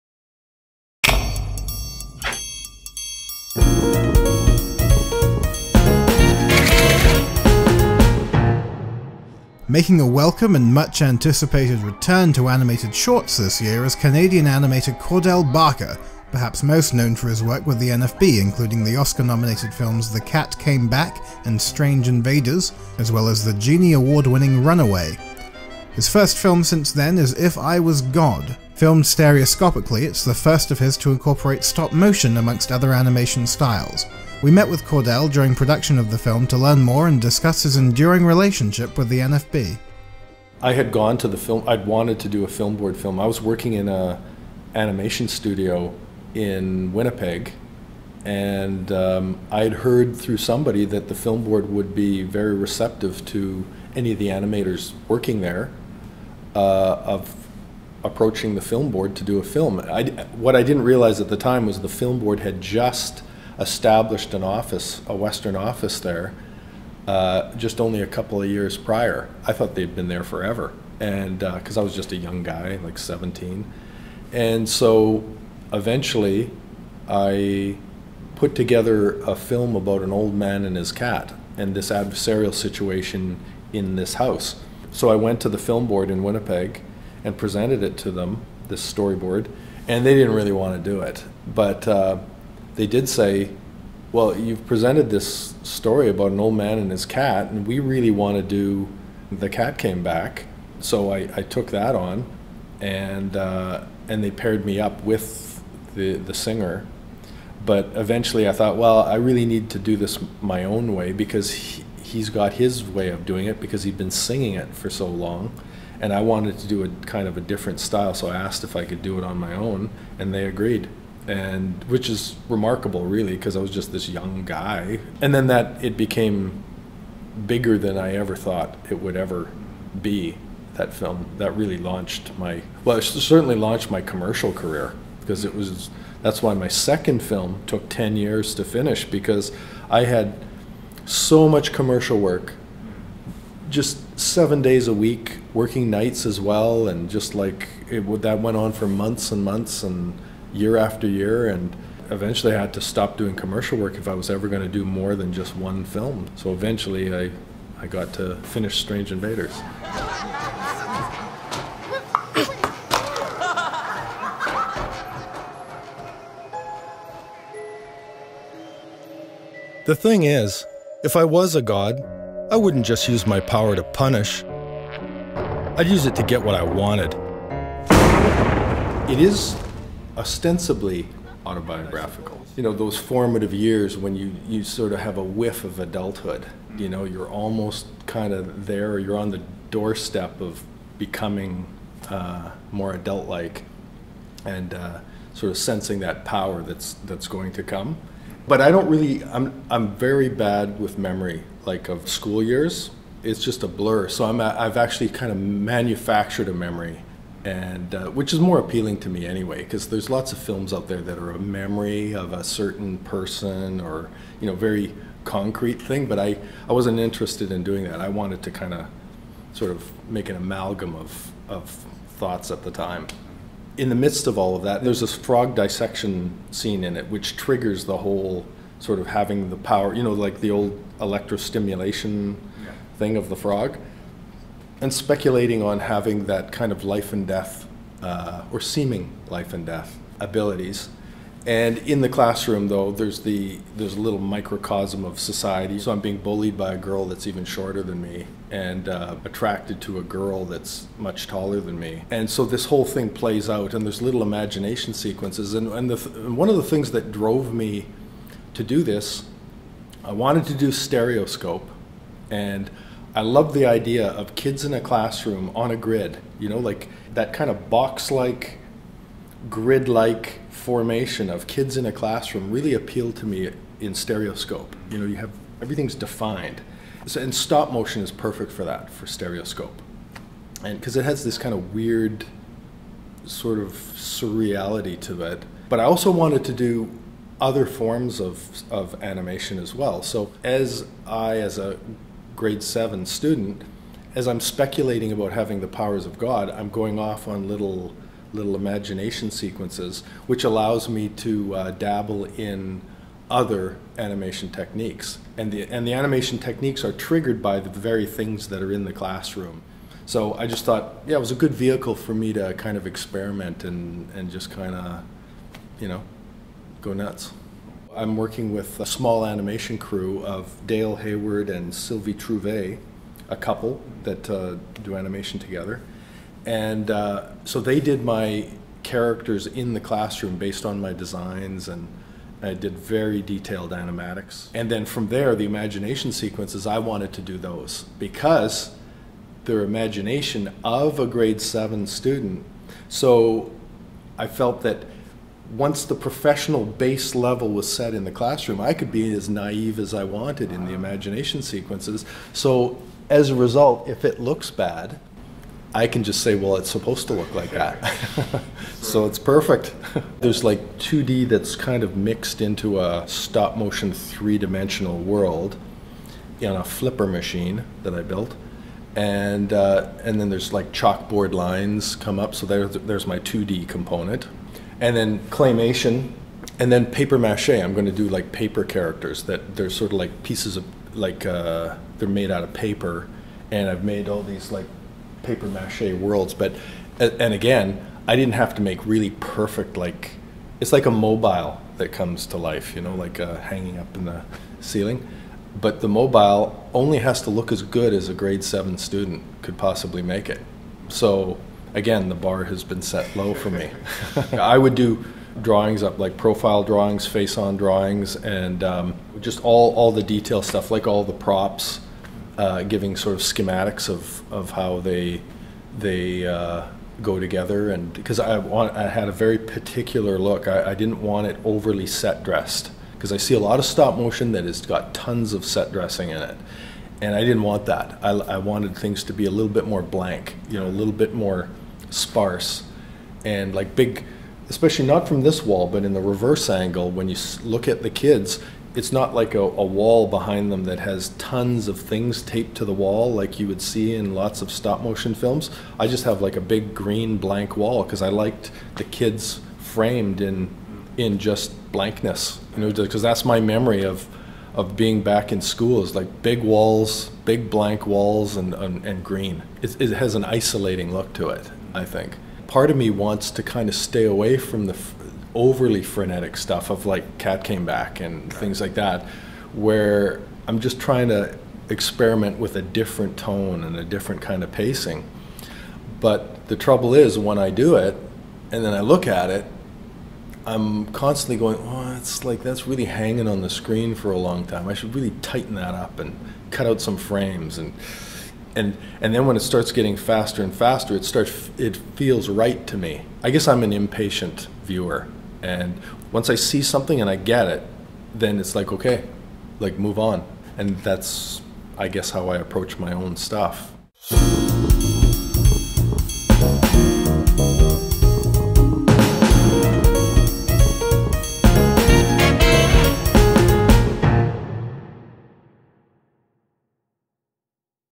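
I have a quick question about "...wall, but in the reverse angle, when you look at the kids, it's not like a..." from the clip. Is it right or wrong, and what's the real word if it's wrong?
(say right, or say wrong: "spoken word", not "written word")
right.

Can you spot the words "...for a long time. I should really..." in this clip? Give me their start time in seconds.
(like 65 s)
483 s.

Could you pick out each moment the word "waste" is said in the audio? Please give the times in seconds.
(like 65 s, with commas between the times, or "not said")
not said.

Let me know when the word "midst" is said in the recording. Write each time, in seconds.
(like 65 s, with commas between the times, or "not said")
223 s.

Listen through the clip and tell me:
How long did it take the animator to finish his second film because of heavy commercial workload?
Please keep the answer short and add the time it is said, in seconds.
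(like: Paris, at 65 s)
10 years, at 137 s.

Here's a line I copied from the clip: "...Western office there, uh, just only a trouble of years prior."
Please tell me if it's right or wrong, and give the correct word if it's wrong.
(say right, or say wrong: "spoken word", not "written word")
wrong: "couple", not "trouble".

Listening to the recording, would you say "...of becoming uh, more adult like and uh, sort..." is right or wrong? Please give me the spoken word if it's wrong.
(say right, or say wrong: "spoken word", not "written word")
right.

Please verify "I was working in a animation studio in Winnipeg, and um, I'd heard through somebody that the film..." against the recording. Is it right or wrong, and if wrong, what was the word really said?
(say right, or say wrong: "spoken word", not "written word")
right.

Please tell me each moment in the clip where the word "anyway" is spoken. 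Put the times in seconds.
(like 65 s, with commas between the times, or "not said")
209 s.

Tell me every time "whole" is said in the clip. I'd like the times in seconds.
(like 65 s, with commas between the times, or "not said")
227 s, 252 s.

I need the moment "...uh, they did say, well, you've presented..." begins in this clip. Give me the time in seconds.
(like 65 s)
91 s.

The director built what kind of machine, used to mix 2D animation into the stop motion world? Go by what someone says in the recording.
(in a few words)
flipper machine.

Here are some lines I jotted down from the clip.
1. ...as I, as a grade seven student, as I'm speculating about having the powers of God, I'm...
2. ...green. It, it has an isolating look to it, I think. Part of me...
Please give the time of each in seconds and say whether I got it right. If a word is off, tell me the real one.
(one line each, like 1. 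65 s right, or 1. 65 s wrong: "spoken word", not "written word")
1. 290 s right
2. 459 s right.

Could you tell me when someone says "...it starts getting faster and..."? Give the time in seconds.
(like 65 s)
489 s.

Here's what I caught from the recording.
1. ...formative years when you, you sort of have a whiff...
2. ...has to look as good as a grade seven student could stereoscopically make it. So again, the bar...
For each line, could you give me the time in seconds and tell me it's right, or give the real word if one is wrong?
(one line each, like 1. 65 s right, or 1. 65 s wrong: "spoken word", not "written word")
1. 182 s right
2. 396 s wrong: "possibly", not "stereoscopically".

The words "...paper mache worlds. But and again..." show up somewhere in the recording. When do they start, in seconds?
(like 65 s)
385 s.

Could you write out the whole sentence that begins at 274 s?
You know, you have everything's defined.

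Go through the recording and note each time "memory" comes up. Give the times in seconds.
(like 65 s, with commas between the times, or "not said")
200 s, 206 s, 211 s, 453 s.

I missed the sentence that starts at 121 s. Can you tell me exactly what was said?
And which is remarkable, really, because I was just this young guy.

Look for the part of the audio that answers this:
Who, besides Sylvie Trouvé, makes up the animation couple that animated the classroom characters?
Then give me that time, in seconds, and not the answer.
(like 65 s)
320 s.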